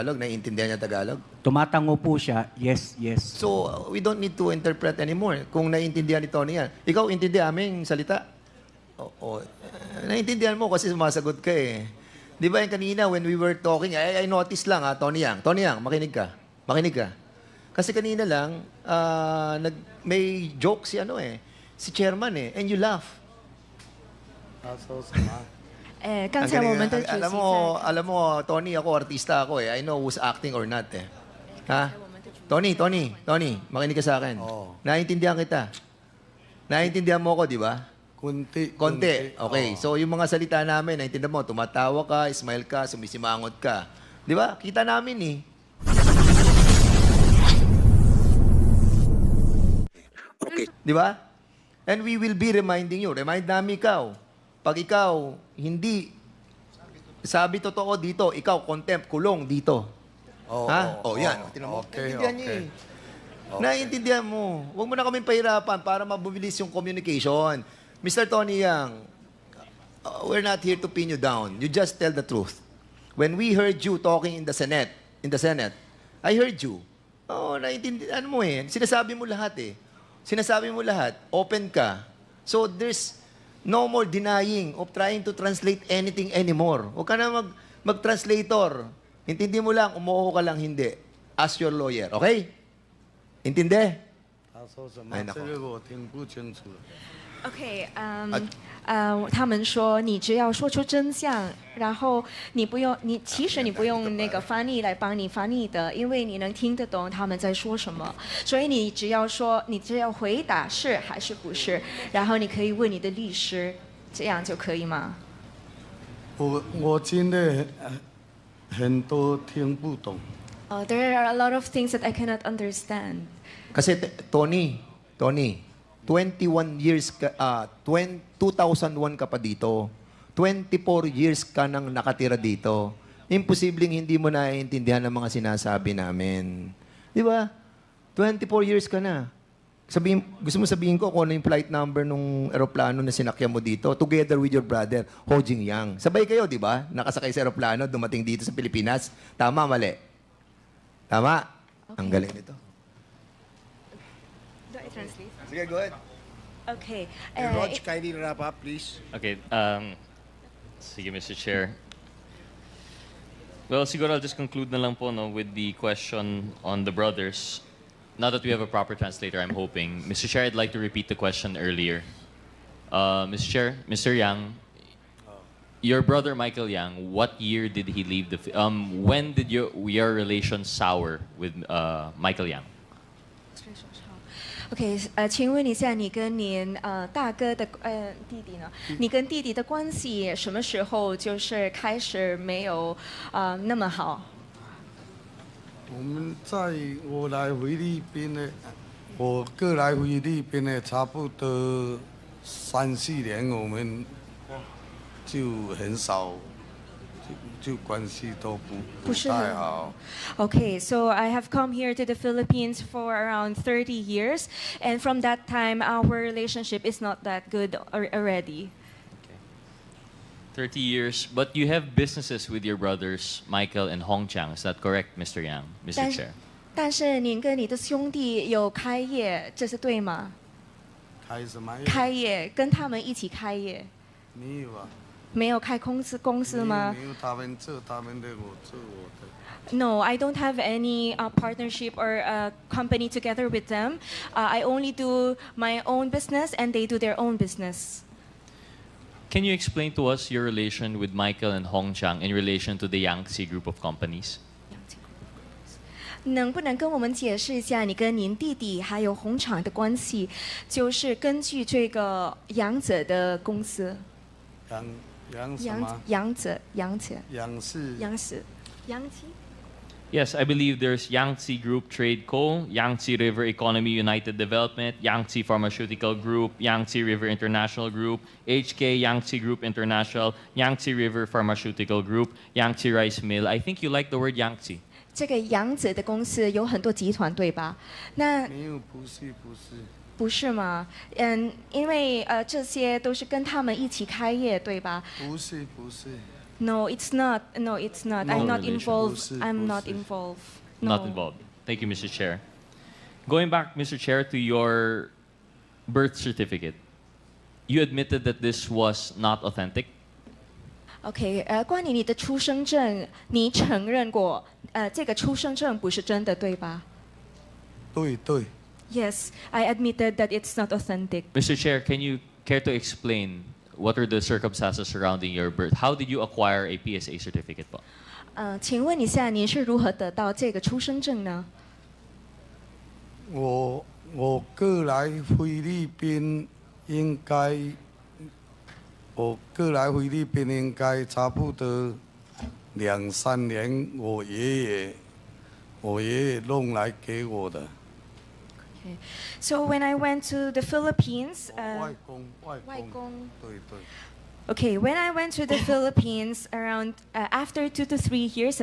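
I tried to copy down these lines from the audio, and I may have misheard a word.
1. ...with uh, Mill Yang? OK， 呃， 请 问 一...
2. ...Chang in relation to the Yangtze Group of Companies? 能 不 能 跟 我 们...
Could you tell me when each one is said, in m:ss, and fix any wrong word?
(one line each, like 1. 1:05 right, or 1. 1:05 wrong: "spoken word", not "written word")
1. 3:01 wrong: "Michael", not "Mill"
2. 4:11 right.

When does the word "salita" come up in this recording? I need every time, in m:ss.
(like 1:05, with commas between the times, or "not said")
0:07, 0:40.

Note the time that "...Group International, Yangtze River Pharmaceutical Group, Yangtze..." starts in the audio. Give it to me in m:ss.
4:39.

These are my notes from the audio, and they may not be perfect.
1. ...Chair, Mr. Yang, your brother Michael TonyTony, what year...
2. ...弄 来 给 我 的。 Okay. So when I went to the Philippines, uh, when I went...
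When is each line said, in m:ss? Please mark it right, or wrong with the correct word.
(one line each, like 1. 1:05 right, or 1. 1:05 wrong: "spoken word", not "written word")
1. 2:53 wrong: "Yang", not "TonyTony"
2. 5:46 right.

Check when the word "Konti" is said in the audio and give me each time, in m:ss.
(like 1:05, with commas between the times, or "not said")
0:38.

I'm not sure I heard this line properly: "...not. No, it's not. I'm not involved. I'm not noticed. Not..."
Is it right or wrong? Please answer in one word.
wrong.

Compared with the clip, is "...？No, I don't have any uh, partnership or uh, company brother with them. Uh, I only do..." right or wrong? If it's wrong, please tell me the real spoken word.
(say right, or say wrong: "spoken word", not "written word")
wrong: "together", not "brother".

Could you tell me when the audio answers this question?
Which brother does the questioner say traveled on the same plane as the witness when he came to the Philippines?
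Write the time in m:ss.
2:25.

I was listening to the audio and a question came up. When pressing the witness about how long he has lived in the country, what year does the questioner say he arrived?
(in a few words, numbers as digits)
2001.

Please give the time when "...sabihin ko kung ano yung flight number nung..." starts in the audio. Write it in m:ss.
2:20.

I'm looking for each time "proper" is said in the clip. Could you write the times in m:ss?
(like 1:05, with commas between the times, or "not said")
2:48.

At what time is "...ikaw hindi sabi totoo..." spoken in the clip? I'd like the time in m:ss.
0:54.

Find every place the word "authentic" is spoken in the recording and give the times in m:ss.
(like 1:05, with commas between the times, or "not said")
5:09, 5:20.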